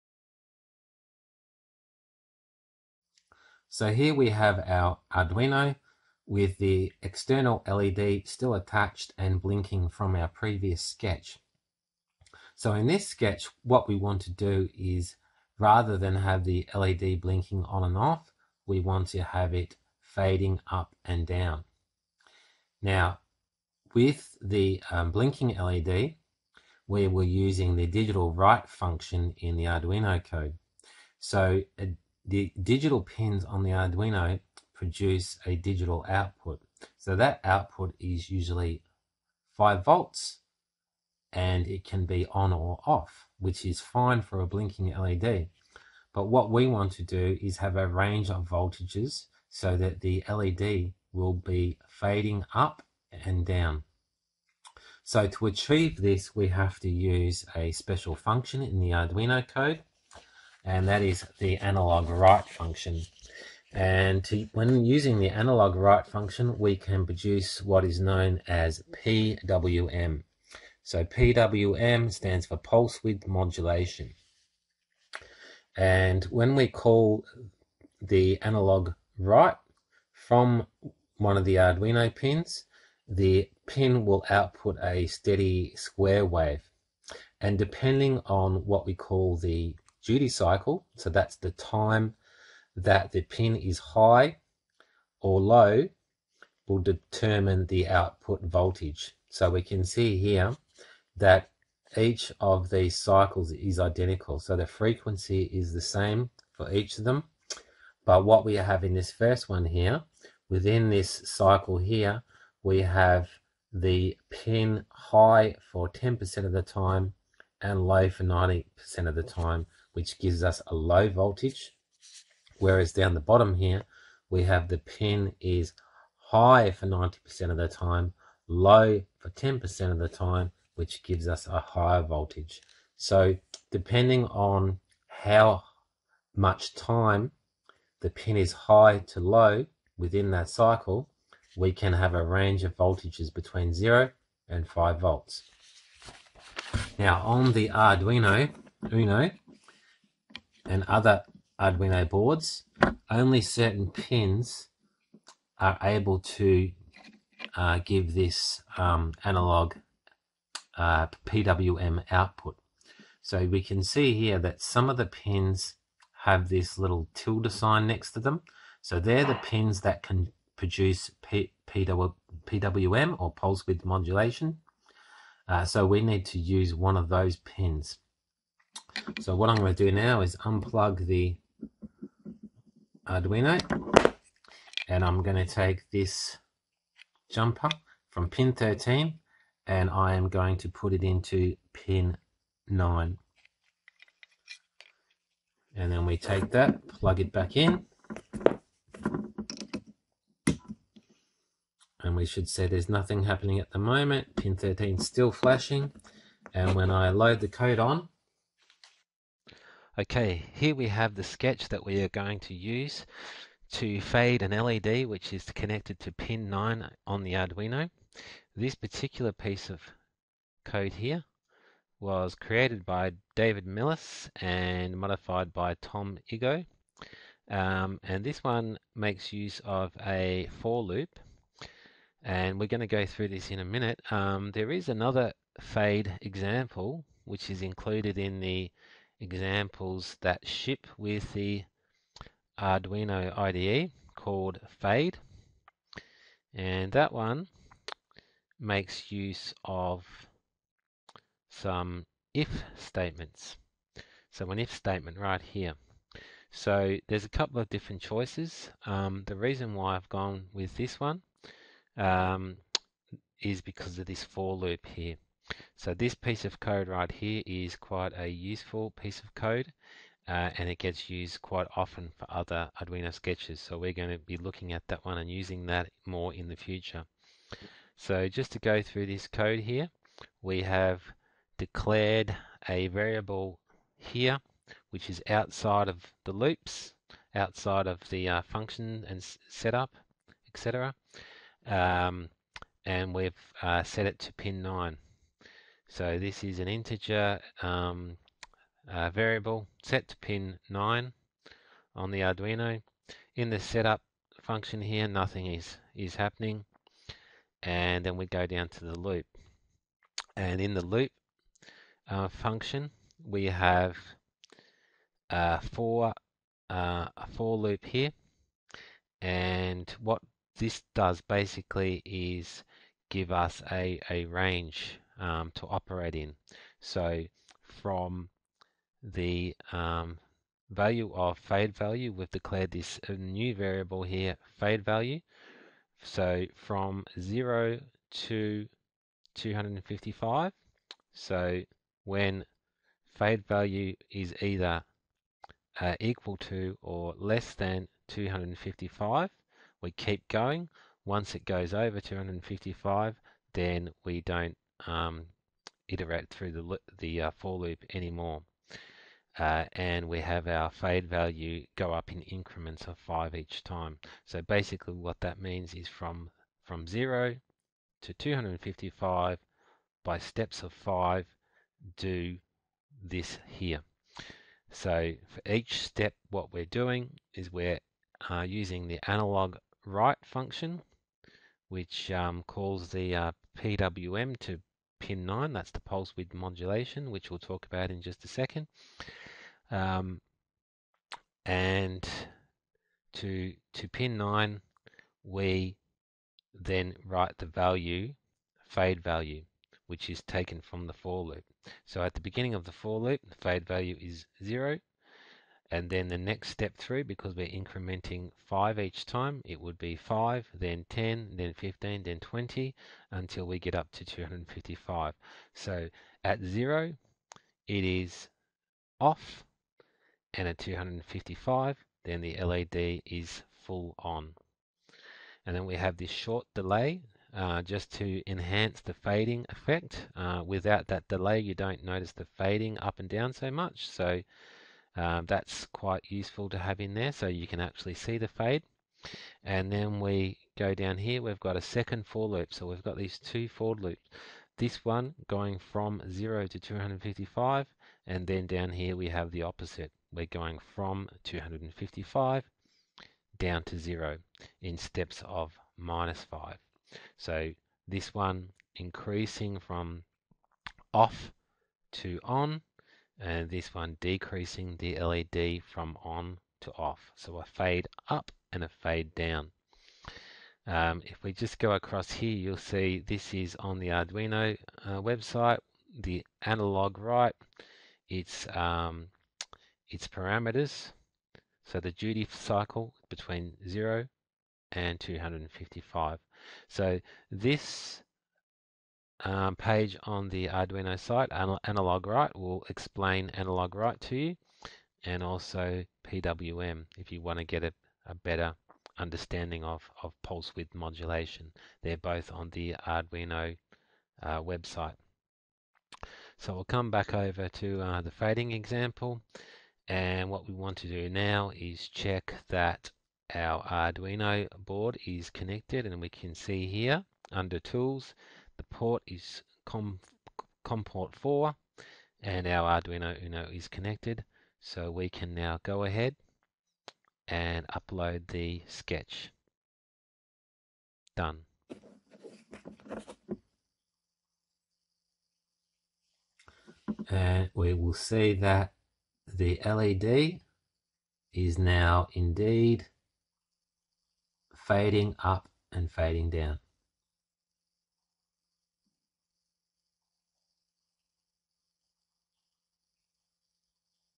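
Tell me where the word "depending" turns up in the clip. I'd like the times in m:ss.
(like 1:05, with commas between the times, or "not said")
1:27, 2:13.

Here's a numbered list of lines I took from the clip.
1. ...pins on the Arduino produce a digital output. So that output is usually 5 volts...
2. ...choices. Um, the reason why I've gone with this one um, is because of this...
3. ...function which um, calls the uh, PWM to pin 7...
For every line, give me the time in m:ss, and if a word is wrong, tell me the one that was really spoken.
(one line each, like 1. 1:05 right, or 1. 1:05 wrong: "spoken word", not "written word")
1. 0:33 right
2. 4:18 right
3. 6:20 wrong: "9", not "7".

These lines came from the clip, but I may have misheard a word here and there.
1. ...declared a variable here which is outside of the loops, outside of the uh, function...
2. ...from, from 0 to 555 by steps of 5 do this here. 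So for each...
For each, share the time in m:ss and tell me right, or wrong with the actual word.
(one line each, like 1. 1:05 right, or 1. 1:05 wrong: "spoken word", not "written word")
1. 4:41 right
2. 6:05 wrong: "255", not "555".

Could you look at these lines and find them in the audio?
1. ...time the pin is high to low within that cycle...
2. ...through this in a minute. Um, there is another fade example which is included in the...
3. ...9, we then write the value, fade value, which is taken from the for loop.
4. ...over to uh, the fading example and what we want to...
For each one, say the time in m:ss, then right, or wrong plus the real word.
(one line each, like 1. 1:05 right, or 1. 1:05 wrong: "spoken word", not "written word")
1. 2:16 right
2. 3:53 right
3. 6:34 right
4. 8:27 right.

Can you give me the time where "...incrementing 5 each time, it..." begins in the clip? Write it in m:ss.
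6:47.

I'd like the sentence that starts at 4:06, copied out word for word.
And that one makes use of some if statements.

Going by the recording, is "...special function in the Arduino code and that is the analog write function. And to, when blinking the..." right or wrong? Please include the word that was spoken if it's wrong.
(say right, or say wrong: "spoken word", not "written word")
wrong: "using", not "blinking".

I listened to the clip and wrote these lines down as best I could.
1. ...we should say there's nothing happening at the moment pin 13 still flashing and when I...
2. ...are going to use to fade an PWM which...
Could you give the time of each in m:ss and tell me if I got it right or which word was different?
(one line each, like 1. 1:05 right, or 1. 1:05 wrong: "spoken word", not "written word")
1. 3:22 right
2. 3:32 wrong: "LED", not "PWM".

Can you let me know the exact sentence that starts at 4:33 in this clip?
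So we're going to be looking at that one and using that more in the future.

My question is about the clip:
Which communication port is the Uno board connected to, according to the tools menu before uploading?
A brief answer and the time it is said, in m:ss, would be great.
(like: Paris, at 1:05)
COM4, at 8:40.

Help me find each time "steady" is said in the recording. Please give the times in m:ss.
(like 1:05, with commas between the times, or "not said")
1:25.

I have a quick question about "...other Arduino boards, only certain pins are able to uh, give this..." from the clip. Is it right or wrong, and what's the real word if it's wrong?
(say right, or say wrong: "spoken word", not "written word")
right.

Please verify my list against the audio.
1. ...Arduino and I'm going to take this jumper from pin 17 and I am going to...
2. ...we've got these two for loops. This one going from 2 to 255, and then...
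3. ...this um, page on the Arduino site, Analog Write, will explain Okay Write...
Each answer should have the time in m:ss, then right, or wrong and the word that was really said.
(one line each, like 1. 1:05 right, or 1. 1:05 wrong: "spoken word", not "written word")
1. 3:03 wrong: "13", not "17"
2. 7:22 wrong: "0", not "2"
3. 8:07 wrong: "Analog", not "Okay".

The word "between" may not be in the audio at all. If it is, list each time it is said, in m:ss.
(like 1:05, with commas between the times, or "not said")
2:23, 8:03.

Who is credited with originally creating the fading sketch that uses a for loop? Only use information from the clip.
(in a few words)
David Mellis.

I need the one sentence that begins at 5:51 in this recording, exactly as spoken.
Once it goes over 255, then we don't um, iterate through the, the uh, for loop anymore.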